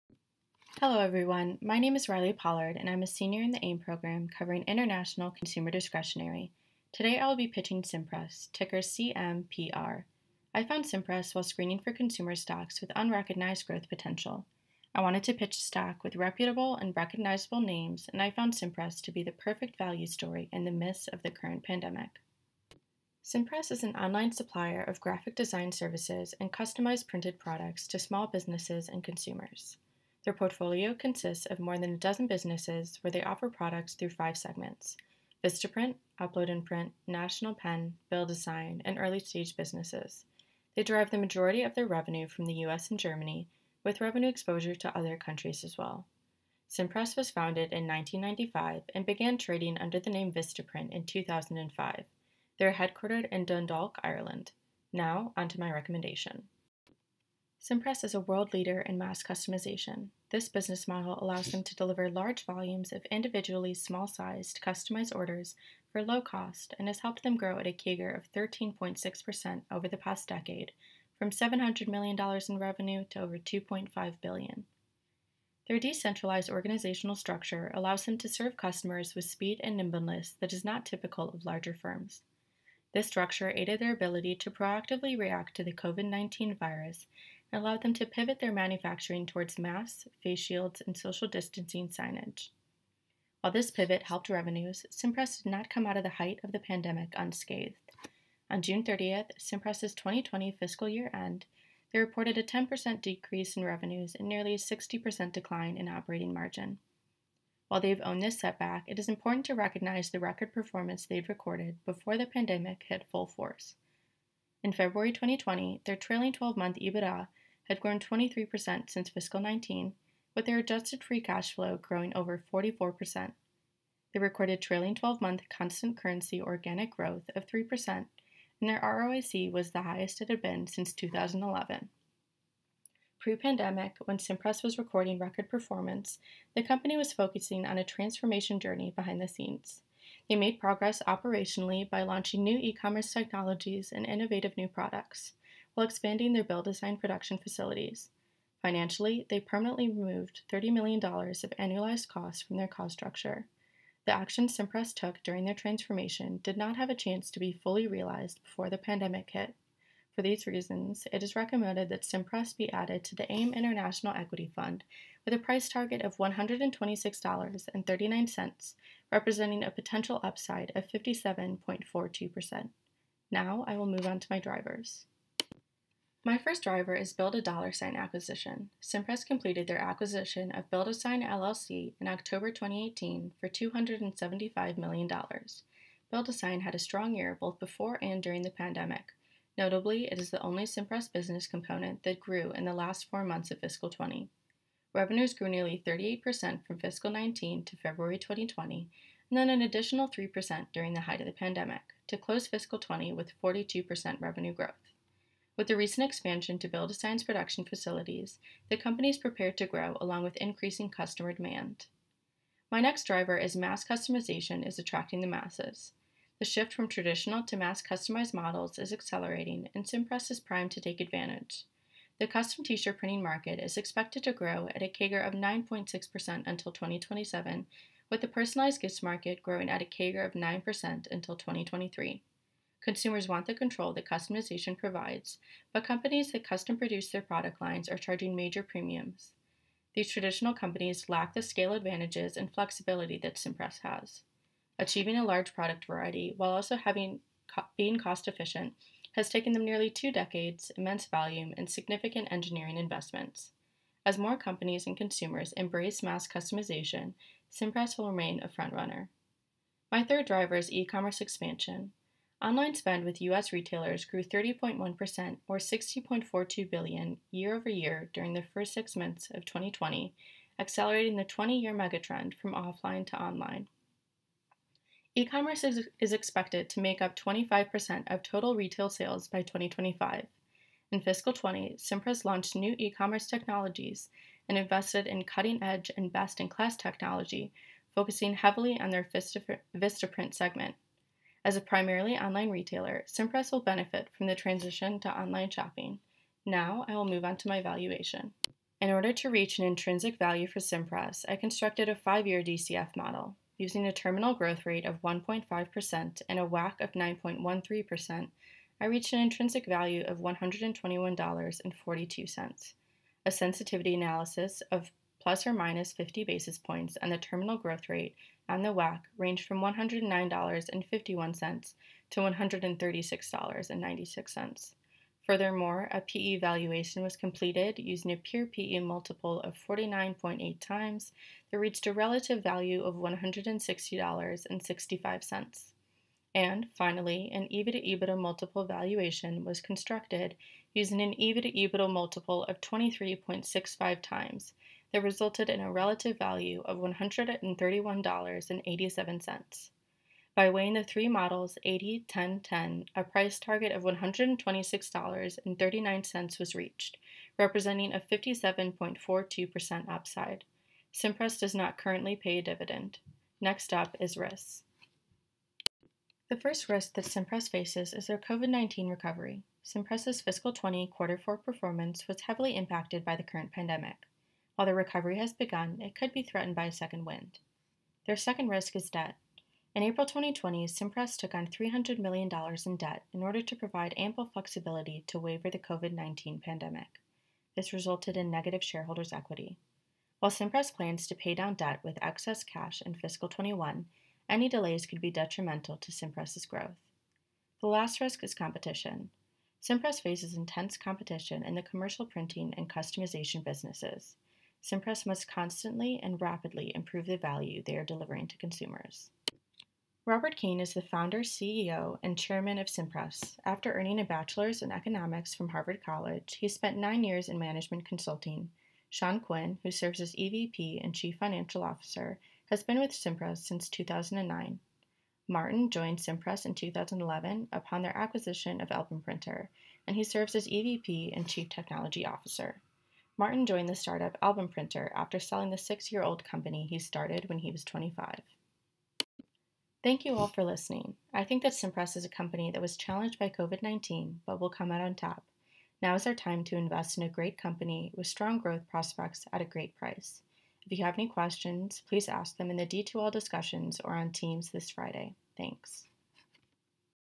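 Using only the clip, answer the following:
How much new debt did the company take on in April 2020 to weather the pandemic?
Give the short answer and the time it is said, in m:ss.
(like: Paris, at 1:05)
$300 million, at 6:21.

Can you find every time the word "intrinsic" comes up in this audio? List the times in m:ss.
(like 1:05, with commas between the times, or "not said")
4:59, 5:09.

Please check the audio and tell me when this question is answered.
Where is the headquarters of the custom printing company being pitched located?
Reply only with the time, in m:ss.
0:53.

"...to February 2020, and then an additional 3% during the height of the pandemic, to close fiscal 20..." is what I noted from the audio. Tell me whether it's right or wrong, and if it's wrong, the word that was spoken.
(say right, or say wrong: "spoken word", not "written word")
right.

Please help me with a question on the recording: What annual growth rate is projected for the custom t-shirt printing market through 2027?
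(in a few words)
9.6%.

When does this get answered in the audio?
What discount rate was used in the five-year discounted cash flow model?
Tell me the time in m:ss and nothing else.
5:06.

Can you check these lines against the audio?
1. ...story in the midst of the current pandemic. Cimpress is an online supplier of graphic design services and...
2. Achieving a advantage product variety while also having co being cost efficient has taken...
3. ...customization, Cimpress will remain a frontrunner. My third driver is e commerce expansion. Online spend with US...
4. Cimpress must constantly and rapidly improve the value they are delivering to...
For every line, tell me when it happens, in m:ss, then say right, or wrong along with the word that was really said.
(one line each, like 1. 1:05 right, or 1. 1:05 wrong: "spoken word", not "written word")
1. 0:20 right
2. 4:04 wrong: "large", not "advantage"
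3. 4:16 right
4. 6:44 right.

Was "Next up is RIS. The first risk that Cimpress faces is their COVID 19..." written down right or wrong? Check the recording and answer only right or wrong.
right.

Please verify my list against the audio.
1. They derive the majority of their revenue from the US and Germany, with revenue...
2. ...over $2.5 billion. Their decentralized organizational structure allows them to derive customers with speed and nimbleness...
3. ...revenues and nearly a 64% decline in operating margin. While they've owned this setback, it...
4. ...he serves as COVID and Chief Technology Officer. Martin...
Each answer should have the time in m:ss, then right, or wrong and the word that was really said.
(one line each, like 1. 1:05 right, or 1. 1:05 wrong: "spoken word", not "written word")
1. 0:40 right
2. 1:13 wrong: "serve", not "derive"
3. 1:43 wrong: "60", not "64"
4. 7:09 wrong: "EVP", not "COVID".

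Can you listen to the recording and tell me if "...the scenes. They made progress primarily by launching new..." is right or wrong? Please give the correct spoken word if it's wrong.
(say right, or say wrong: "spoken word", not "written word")
wrong: "operationally", not "primarily".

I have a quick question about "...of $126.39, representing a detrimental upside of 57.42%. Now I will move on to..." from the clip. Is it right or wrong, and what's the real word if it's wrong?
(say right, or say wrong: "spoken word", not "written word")
wrong: "potential", not "detrimental".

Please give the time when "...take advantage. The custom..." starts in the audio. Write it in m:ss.
3:40.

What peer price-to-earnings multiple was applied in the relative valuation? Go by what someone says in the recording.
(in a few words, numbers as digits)
49.8 times.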